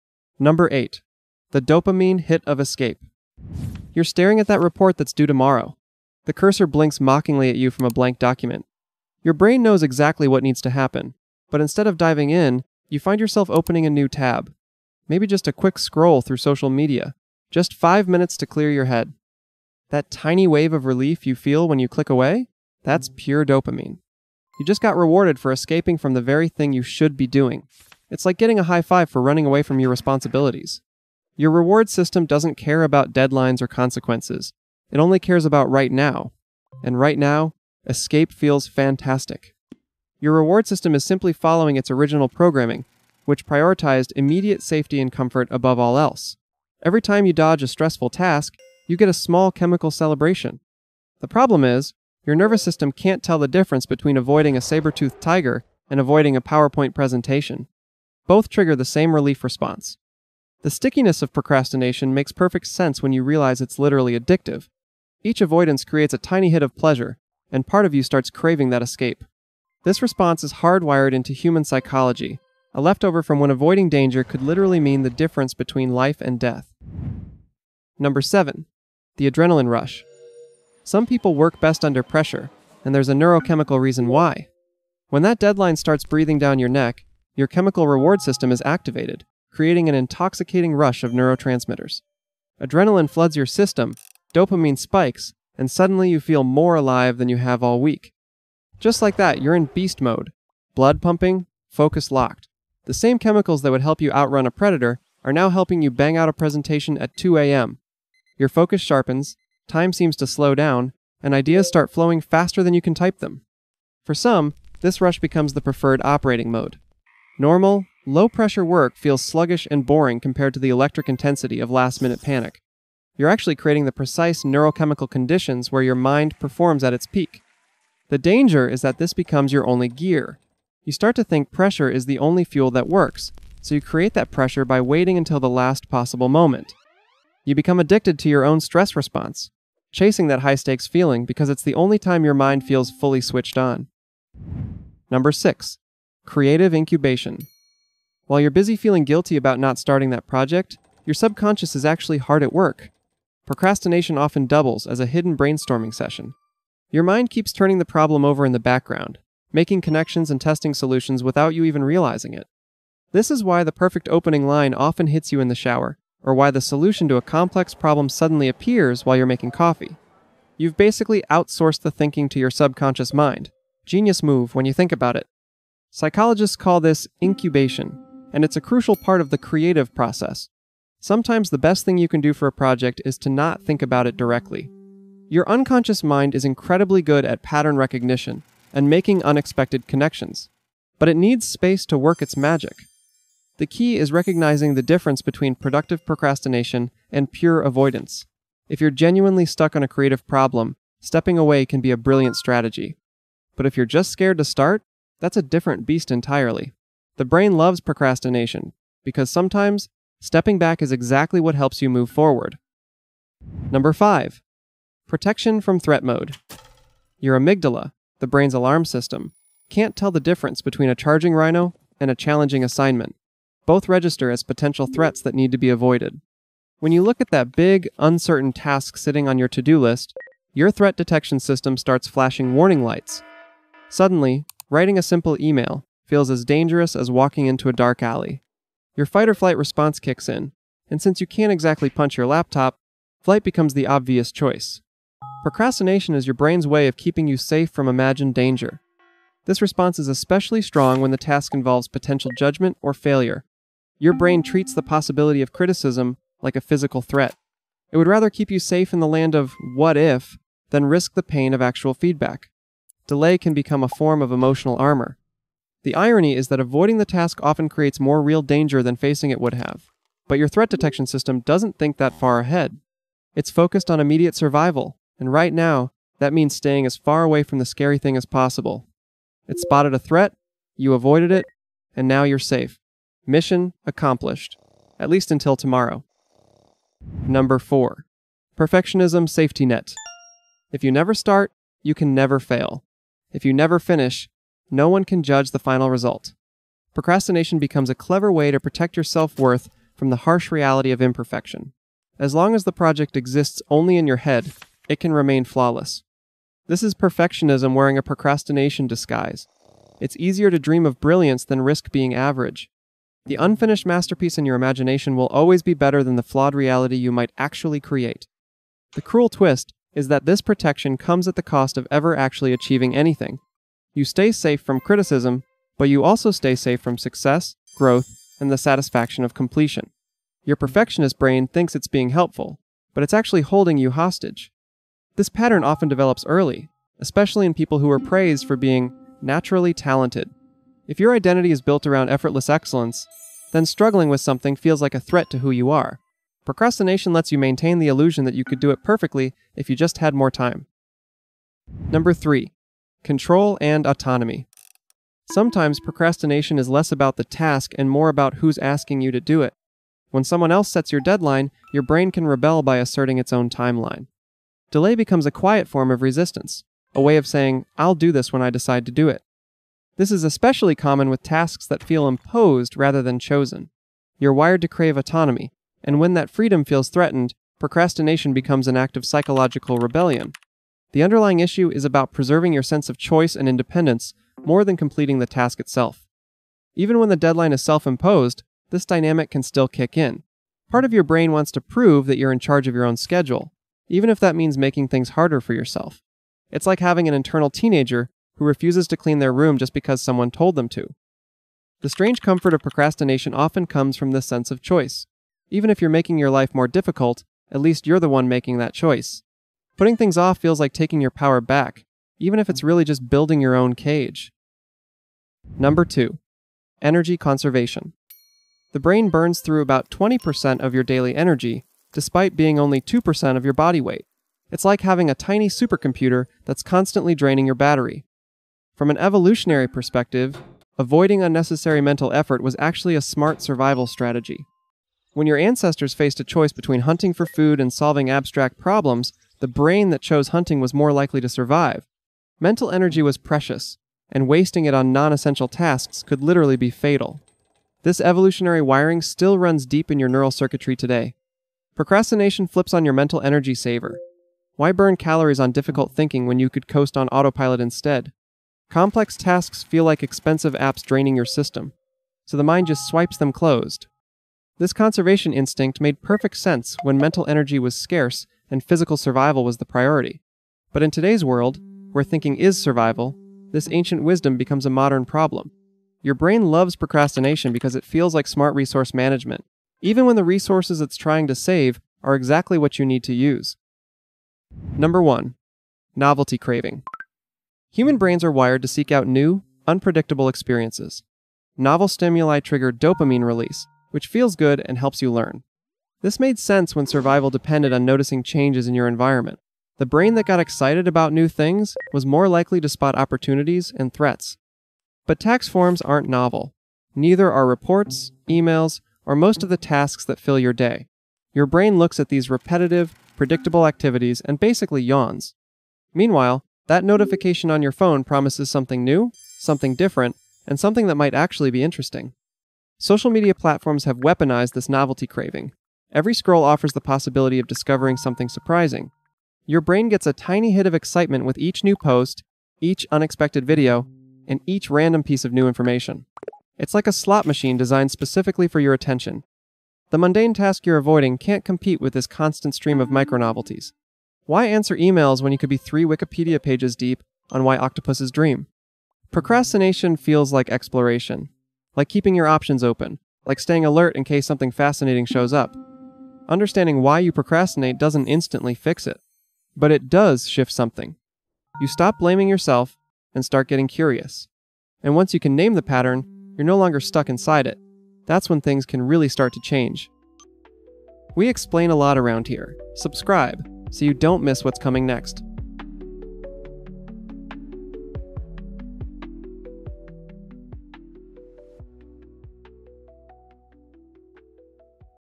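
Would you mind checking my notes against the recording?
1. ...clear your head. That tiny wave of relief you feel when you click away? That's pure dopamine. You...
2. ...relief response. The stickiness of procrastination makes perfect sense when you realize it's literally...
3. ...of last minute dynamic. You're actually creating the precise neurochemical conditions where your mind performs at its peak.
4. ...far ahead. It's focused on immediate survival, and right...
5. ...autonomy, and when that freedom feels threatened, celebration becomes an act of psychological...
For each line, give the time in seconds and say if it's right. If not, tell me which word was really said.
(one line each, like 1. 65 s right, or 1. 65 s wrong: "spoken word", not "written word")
1. 18 s right
2. 59 s right
3. 121 s wrong: "panic", not "dynamic"
4. 272 s right
5. 374 s wrong: "procrastination", not "celebration".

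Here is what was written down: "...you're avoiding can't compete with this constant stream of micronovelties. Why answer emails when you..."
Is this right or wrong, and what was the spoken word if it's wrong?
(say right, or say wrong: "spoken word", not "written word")
right.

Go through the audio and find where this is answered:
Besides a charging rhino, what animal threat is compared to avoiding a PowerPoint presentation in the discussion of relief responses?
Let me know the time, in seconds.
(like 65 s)
54 s.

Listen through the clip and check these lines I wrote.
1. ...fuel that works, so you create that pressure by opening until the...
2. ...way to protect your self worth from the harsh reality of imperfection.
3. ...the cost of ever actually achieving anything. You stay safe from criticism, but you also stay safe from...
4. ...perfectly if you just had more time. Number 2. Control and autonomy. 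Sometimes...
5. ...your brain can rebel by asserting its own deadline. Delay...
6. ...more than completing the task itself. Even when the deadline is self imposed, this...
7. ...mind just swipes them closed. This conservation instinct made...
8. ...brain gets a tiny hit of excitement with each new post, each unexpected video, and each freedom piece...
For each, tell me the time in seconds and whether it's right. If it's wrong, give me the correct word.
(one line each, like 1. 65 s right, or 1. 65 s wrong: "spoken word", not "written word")
1. 132 s wrong: "waiting", not "opening"
2. 298 s right
3. 321 s right
4. 348 s wrong: "3", not "2"
5. 361 s wrong: "timeline", not "deadline"
6. 384 s right
7. 462 s right
8. 529 s wrong: "random", not "freedom".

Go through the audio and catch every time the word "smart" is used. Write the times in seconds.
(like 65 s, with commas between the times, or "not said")
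433 s, 478 s.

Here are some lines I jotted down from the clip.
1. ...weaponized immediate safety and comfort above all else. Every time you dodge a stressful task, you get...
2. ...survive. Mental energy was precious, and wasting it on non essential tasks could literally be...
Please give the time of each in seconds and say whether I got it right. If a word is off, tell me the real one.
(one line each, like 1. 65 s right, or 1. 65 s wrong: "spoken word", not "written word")
1. 43 s wrong: "prioritized", not "weaponized"
2. 441 s right.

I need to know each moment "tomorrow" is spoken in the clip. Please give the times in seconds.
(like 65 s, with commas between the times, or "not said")
5 s, 285 s.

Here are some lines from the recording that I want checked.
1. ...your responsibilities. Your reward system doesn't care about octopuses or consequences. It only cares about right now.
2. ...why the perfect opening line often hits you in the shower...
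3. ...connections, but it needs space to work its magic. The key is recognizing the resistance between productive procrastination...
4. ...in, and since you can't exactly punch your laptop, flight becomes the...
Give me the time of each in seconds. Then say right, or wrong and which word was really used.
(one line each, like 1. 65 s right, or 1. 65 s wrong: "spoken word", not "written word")
1. 29 s wrong: "deadlines", not "octopuses"
2. 163 s right
3. 189 s wrong: "difference", not "resistance"
4. 240 s right.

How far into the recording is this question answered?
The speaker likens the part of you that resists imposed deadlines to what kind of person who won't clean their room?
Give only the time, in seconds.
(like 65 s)
397 s.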